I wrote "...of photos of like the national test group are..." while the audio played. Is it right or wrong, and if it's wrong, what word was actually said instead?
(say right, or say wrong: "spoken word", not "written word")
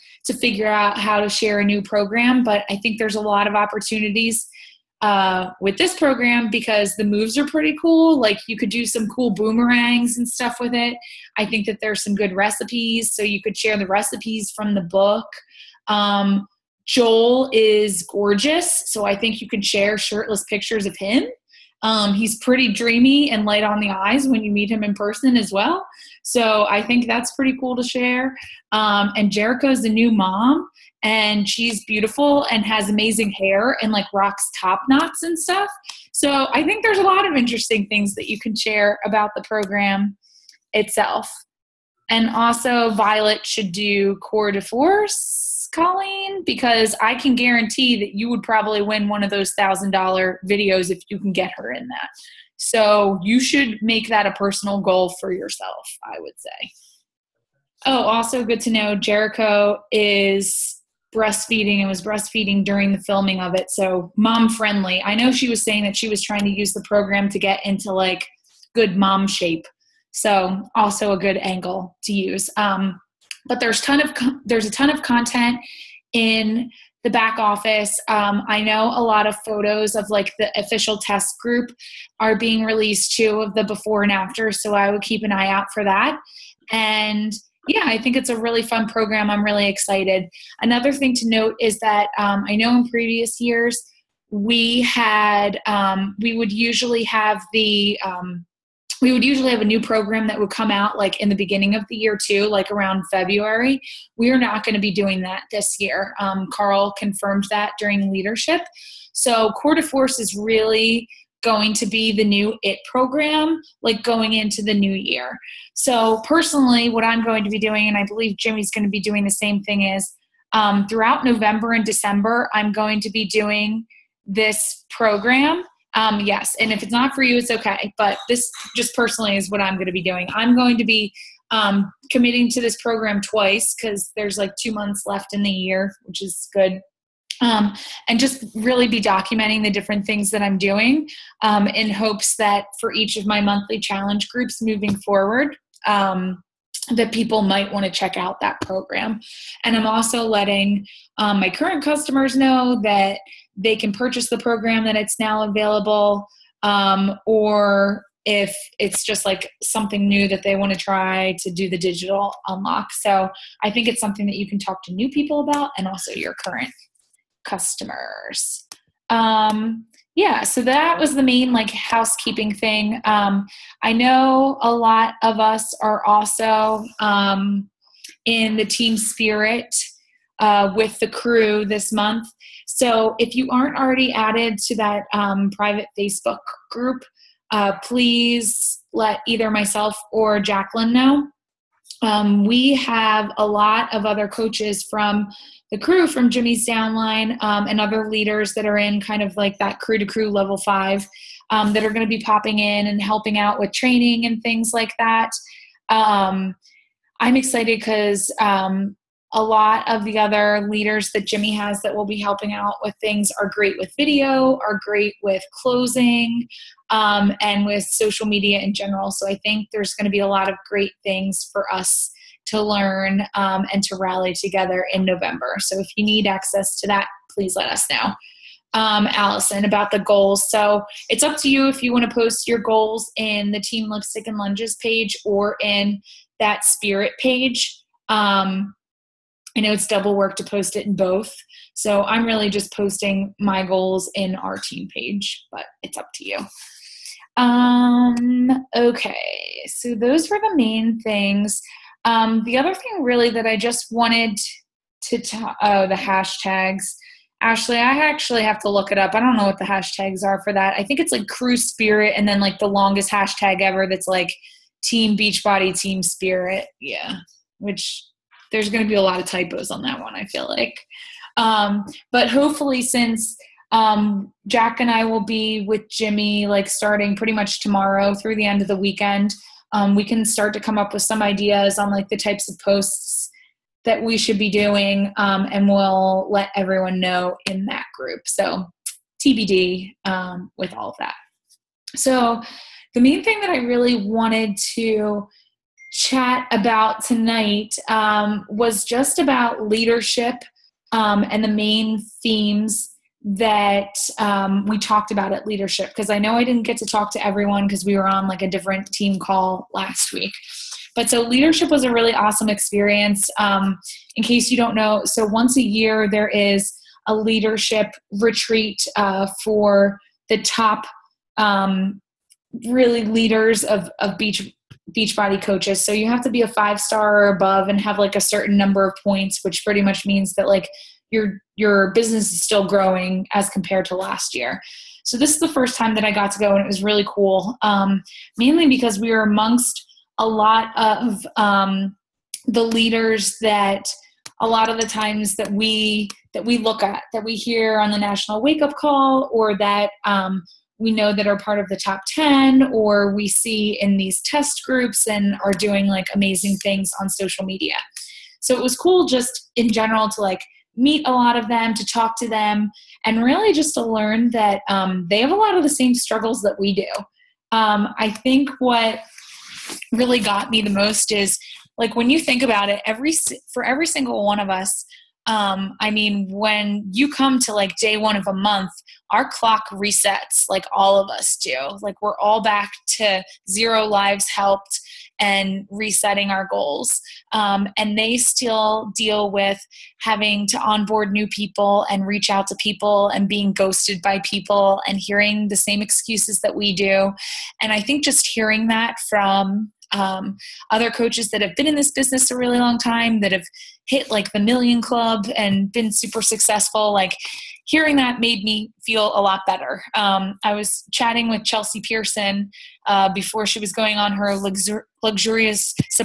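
wrong: "official", not "national".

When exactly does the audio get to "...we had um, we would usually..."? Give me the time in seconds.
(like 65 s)
94 s.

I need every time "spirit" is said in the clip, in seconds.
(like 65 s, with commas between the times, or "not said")
178 s, 236 s, 261 s, 266 s.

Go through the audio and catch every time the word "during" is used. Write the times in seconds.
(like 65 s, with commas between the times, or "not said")
62 s, 107 s.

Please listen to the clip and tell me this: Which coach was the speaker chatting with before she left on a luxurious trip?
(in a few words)
Chelsea Pearson.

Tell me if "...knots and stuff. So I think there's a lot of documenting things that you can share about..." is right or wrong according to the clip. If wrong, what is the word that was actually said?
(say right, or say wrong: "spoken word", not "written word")
wrong: "interesting", not "documenting".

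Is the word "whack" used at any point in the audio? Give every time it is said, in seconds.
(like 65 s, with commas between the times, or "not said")
not said.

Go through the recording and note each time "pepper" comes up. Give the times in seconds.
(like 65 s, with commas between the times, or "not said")
not said.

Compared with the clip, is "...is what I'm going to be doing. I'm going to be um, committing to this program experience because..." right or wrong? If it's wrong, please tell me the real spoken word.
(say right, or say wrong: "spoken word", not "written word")
wrong: "twice", not "experience".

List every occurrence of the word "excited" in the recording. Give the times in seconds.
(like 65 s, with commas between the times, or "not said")
89 s, 207 s.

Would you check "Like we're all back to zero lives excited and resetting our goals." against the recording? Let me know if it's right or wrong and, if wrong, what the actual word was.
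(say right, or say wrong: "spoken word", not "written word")
wrong: "helped", not "excited".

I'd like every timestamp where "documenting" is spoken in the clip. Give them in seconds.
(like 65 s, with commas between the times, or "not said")
139 s.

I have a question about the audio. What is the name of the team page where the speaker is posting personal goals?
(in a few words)
Team Lipstick and Lunges.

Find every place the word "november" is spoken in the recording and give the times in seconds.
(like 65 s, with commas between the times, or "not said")
121 s, 225 s.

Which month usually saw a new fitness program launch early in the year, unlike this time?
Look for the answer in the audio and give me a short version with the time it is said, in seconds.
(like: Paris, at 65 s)
February, at 103 s.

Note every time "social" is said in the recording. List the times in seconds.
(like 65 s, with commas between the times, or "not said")
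217 s, 357 s.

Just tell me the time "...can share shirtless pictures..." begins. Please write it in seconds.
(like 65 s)
19 s.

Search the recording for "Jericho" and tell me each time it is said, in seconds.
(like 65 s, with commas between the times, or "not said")
29 s, 58 s.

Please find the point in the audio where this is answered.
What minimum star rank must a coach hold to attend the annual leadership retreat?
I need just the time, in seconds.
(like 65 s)
326 s.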